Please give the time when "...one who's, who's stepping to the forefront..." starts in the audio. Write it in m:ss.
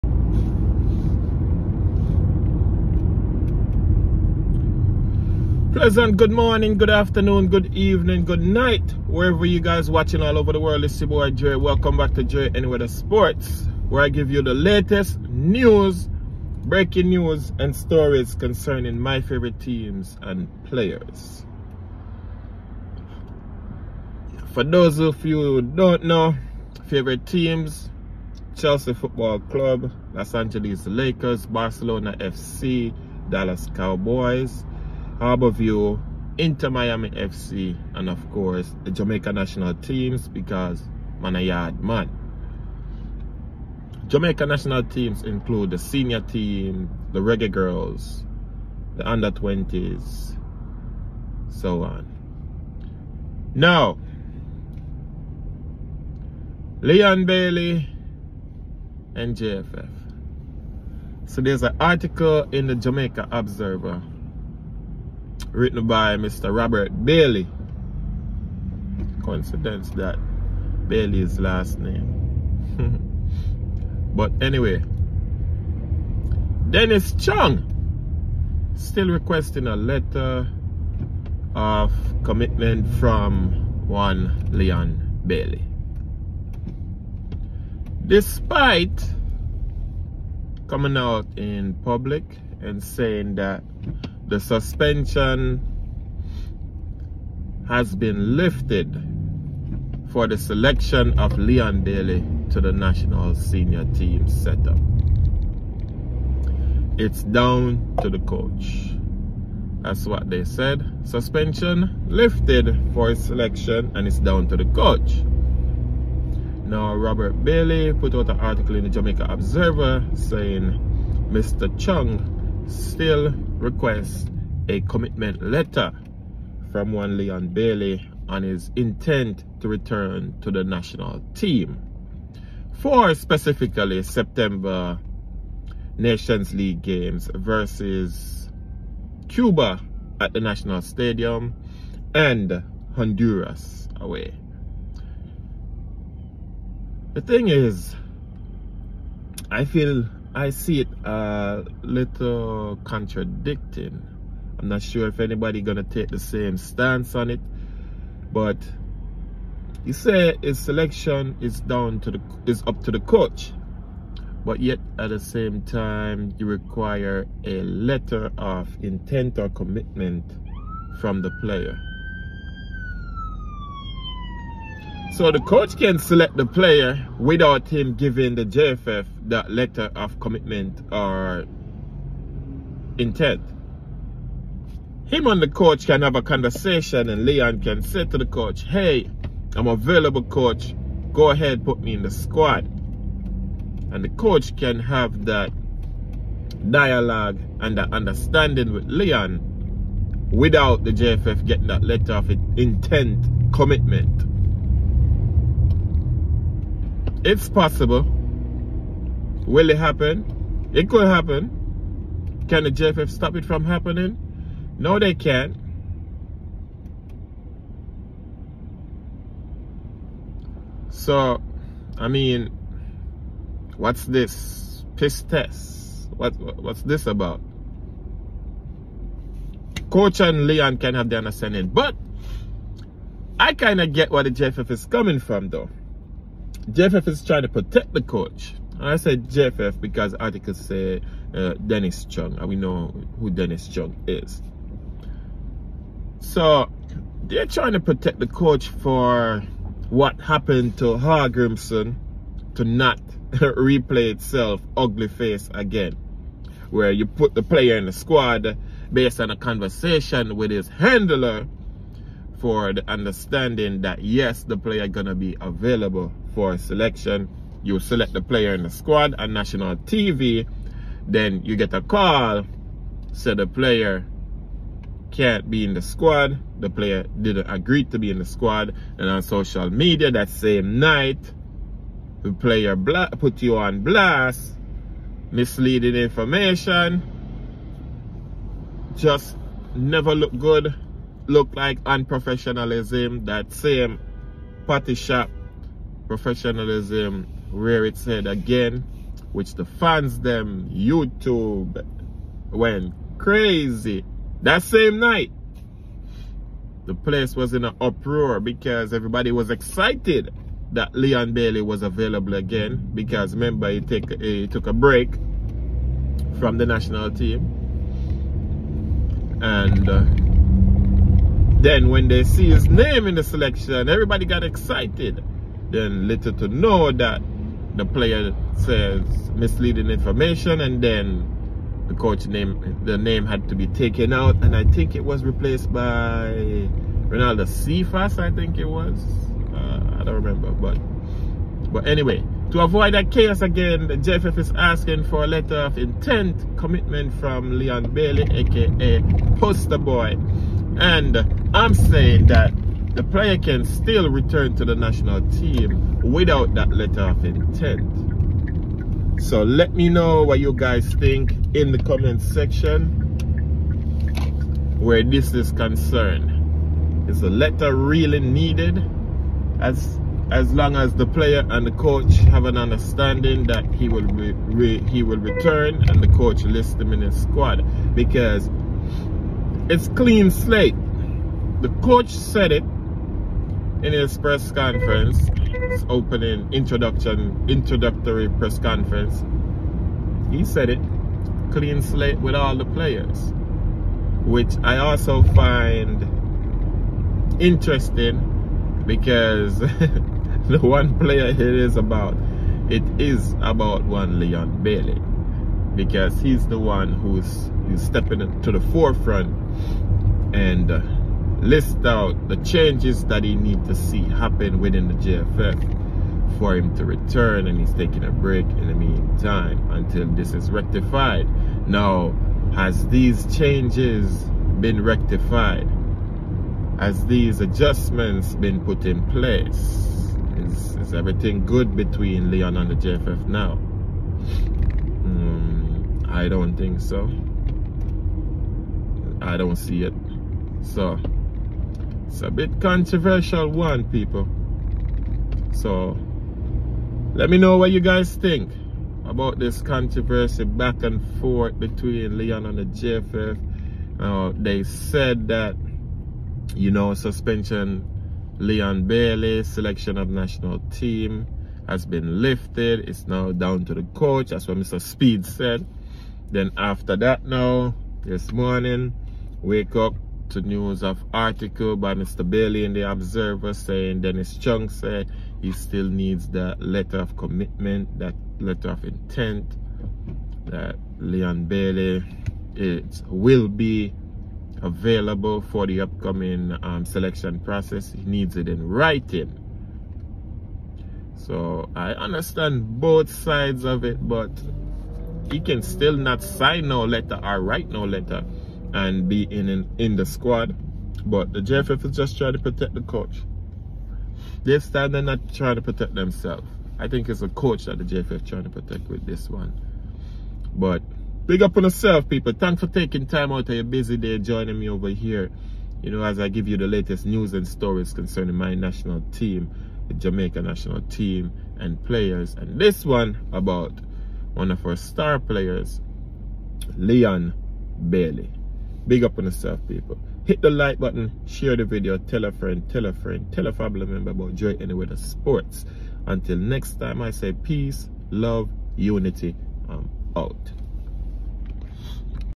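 6:46.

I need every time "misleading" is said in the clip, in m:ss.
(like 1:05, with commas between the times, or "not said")
4:45, 5:29.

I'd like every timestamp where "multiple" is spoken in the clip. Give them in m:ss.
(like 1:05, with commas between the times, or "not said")
not said.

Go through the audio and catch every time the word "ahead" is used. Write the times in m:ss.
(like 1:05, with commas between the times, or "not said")
3:11.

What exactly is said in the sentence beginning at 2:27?
The thing is, I feel I see it a little contradicting.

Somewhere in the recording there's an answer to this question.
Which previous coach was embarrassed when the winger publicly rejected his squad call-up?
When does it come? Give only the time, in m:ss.
4:10.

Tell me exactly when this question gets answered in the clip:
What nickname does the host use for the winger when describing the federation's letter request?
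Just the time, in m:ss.
5:49.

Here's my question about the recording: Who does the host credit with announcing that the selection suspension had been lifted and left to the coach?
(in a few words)
Mr. Speed.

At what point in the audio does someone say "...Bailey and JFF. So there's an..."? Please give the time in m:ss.
0:57.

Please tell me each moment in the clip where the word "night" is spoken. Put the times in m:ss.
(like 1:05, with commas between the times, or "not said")
0:08, 4:40, 5:04.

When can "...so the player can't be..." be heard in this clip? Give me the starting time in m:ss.
4:33.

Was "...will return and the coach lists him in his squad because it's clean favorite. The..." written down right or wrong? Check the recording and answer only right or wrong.
wrong.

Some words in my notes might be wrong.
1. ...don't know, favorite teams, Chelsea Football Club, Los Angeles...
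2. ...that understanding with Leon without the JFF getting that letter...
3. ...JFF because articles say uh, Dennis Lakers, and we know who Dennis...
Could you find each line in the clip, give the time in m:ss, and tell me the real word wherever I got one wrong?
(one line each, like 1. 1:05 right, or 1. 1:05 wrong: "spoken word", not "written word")
1. 0:25 right
2. 3:17 right
3. 3:59 wrong: "Chung", not "Lakers".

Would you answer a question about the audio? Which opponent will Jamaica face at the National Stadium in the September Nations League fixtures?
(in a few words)
Cuba.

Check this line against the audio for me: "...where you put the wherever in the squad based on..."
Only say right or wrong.
wrong.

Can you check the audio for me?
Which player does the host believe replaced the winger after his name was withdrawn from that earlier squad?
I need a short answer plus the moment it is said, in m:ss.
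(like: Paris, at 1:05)
Renaldo Cephas, at 5:37.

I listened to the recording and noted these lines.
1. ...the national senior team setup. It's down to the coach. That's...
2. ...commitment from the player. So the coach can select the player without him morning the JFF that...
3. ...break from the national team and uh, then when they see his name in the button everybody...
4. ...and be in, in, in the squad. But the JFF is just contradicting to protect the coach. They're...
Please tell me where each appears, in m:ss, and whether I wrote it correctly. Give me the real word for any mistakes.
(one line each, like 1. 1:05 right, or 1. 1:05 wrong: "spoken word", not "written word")
1. 1:42 right
2. 2:49 wrong: "giving", not "morning"
3. 5:14 wrong: "selection", not "button"
4. 8:18 wrong: "trying", not "contradicting".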